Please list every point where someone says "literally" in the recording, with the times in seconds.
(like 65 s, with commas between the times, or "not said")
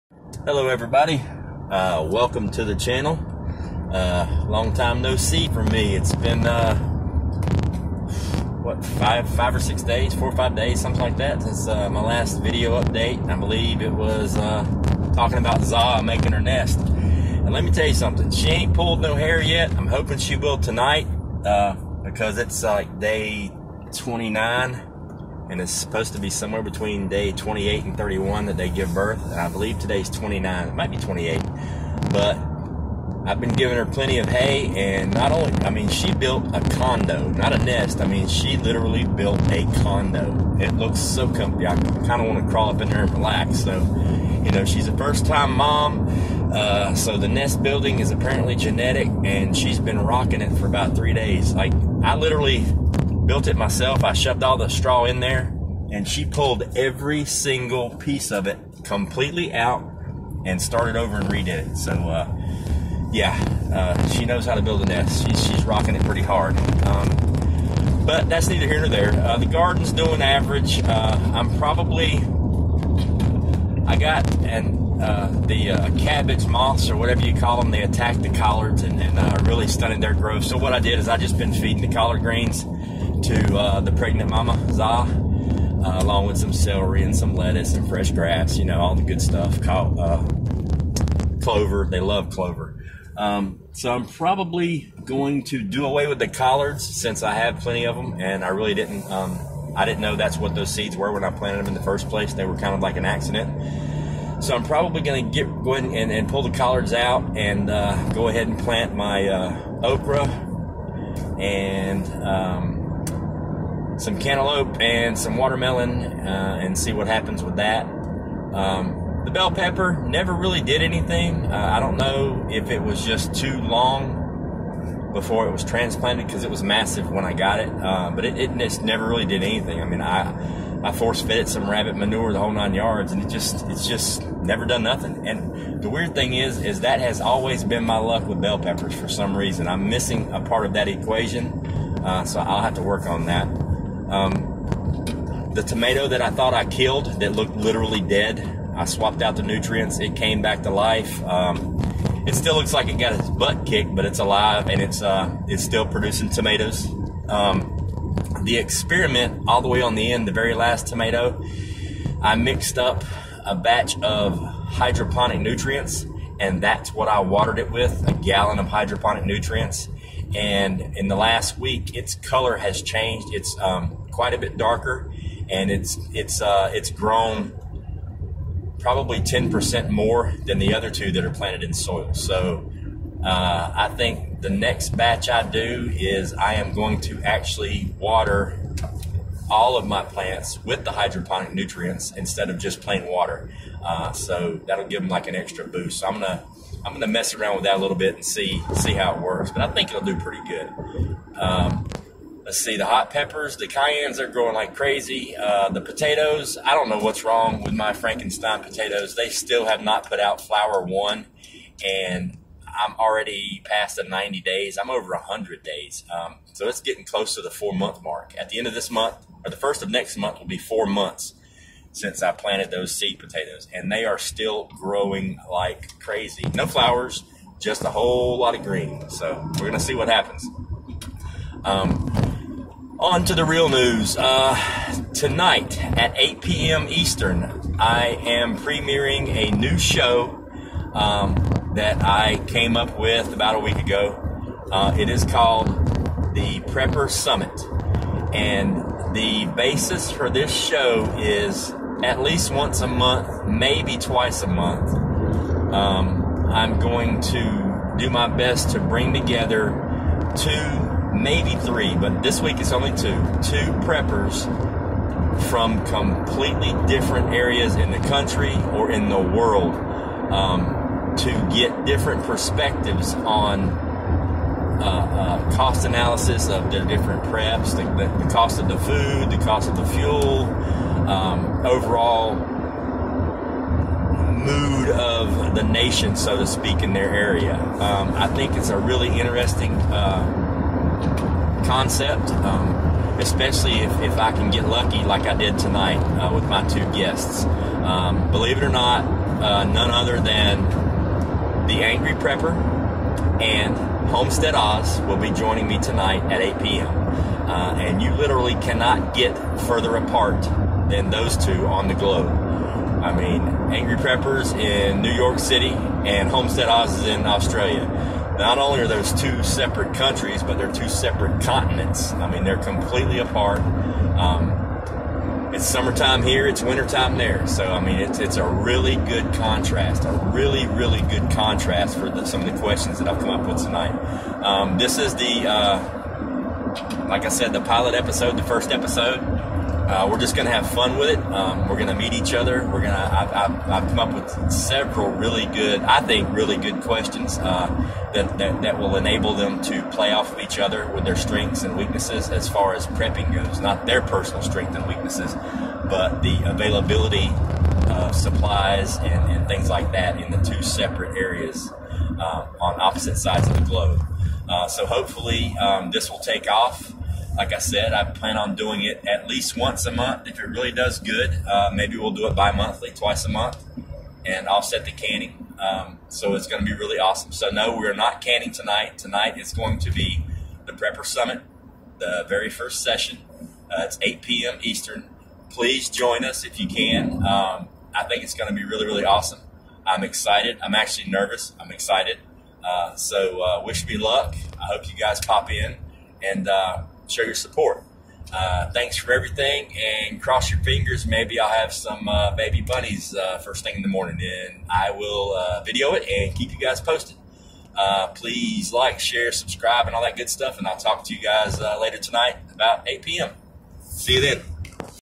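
38 s, 52 s, 147 s, 308 s.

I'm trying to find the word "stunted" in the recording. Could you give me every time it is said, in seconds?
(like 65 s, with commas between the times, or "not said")
79 s.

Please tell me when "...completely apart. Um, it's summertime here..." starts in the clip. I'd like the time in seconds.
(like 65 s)
322 s.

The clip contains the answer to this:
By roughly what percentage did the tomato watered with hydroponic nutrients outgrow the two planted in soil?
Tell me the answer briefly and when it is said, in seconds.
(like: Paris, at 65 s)
10%, at 179 s.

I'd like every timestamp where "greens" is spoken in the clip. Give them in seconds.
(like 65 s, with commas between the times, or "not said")
82 s, 228 s.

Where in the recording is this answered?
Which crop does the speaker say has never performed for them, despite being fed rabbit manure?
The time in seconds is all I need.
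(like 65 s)
119 s.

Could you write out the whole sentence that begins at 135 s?
And the weird thing is, is that has always been my luck with bell peppers for some reason.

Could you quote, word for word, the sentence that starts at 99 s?
Um, I didn't know that's what those seeds were when I planted them in the first place.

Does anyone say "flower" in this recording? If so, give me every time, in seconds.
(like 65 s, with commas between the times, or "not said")
210 s, 226 s.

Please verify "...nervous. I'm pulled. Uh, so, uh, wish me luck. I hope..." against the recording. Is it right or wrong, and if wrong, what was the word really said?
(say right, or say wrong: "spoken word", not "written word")
wrong: "excited", not "pulled".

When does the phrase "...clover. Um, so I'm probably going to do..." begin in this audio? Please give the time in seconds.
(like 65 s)
92 s.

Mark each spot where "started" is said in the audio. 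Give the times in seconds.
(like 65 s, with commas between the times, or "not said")
60 s.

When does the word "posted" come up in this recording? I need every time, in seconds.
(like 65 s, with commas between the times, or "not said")
406 s.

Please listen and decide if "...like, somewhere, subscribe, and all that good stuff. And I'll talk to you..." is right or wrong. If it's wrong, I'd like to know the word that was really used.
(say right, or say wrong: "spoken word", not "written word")
wrong: "share", not "somewhere".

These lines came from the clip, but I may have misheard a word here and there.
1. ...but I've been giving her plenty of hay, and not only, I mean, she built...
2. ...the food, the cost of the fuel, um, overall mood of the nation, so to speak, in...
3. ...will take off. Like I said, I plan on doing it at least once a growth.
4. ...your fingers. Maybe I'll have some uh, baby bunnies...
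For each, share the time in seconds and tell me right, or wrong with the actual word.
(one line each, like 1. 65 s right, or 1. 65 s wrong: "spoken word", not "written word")
1. 32 s right
2. 278 s right
3. 366 s wrong: "month", not "growth"
4. 400 s right.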